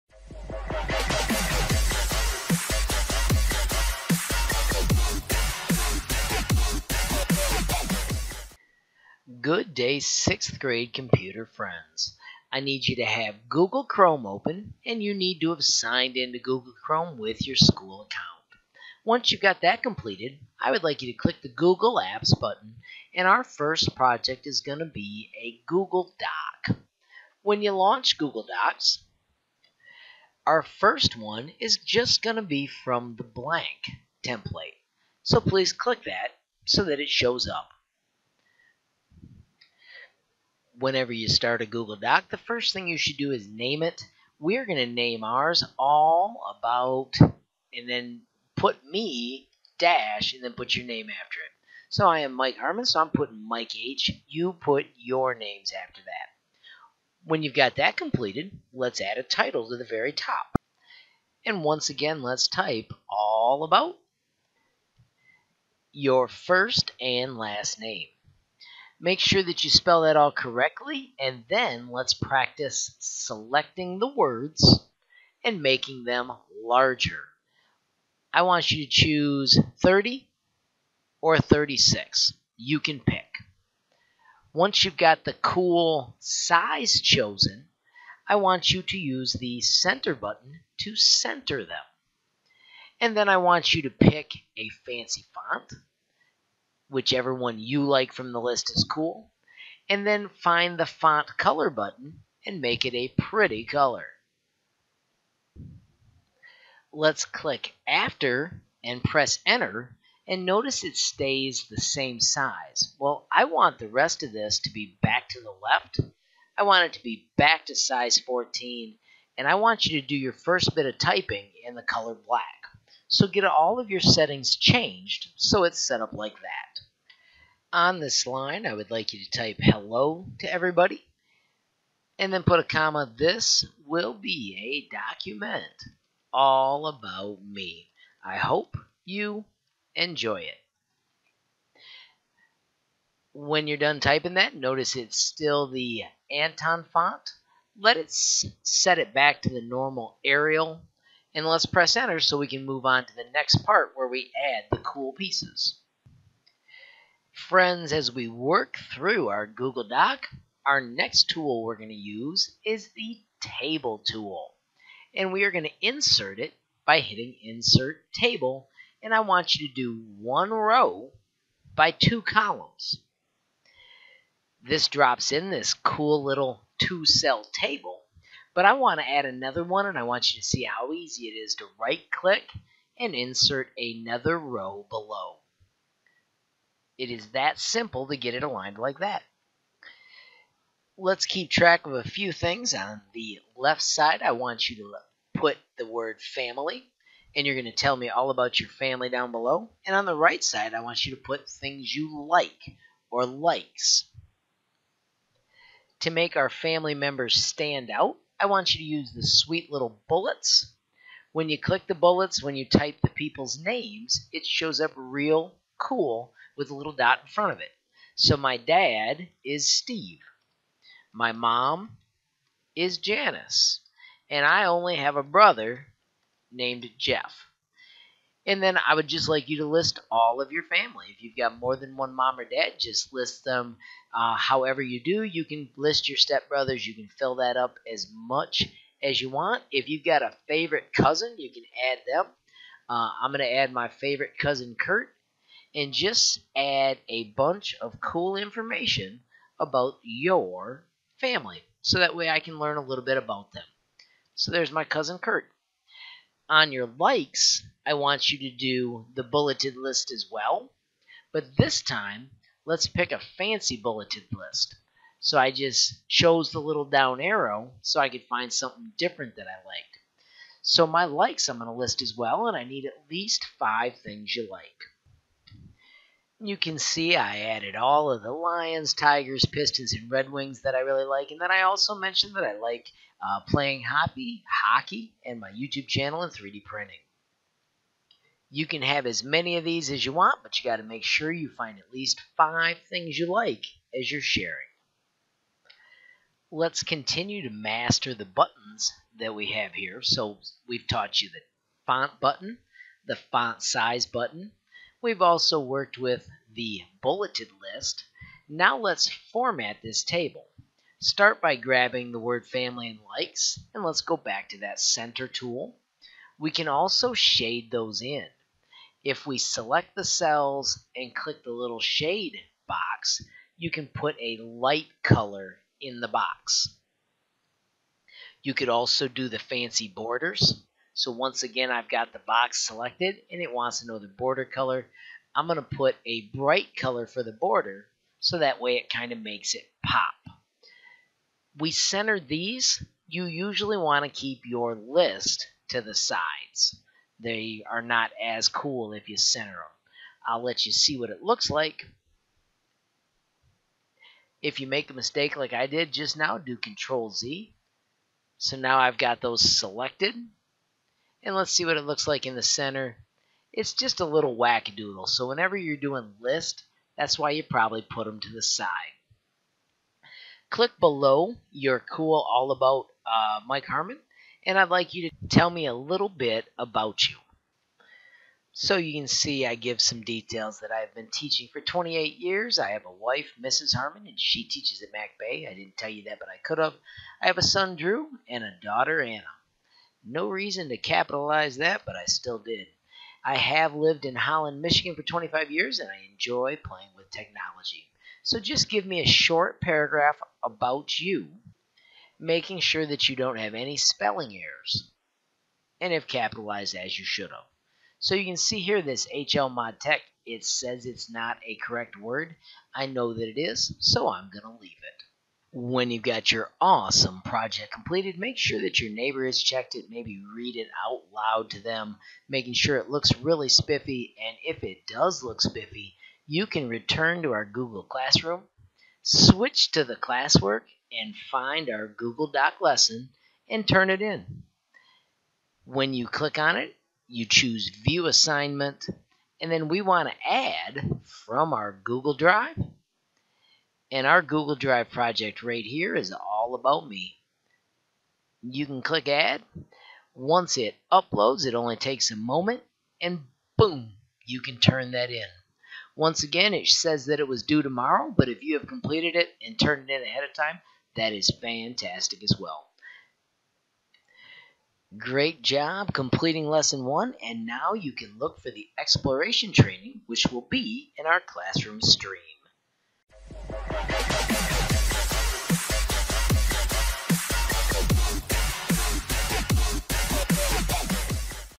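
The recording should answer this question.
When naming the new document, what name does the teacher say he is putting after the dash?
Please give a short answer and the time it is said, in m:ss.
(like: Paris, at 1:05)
Mike H, at 0:53.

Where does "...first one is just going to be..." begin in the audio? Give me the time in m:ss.
0:30.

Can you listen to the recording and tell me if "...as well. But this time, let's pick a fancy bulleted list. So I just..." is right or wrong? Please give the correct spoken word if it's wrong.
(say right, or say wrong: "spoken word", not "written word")
right.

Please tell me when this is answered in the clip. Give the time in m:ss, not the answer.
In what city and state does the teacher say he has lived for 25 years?
6:34.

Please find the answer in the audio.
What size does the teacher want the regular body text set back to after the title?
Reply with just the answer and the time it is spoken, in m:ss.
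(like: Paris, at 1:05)
14, at 1:58.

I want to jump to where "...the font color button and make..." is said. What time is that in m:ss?
1:40.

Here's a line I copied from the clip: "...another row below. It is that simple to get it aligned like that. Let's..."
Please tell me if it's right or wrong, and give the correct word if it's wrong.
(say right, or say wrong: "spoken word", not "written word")
right.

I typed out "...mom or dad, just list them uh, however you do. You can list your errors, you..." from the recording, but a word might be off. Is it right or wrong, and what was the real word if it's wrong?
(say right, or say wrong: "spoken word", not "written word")
wrong: "stepbrothers", not "errors".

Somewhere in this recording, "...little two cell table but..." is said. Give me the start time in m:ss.
2:56.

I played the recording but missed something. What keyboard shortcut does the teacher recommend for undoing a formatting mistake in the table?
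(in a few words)
Control Z.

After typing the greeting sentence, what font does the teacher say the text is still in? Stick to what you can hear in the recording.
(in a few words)
Anton.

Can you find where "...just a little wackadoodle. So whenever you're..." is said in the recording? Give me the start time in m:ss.
6:03.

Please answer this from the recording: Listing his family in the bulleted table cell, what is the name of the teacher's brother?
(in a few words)
Jeff.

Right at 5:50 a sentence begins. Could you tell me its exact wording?
I'll let you see what it looks like.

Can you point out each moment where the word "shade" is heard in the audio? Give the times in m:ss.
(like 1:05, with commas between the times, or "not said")
5:17, 5:21.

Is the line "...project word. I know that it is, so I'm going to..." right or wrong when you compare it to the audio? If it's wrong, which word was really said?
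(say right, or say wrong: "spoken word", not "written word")
wrong: "correct", not "project".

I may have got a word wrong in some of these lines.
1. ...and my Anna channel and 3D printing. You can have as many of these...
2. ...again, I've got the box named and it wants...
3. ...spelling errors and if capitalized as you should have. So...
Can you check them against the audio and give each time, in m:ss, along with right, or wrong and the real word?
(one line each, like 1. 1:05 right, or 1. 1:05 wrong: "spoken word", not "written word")
1. 4:45 wrong: "YouTube", not "Anna"
2. 5:31 wrong: "selected", not "named"
3. 6:43 right.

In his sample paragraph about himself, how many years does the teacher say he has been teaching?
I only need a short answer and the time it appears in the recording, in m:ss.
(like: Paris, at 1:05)
28, at 6:21.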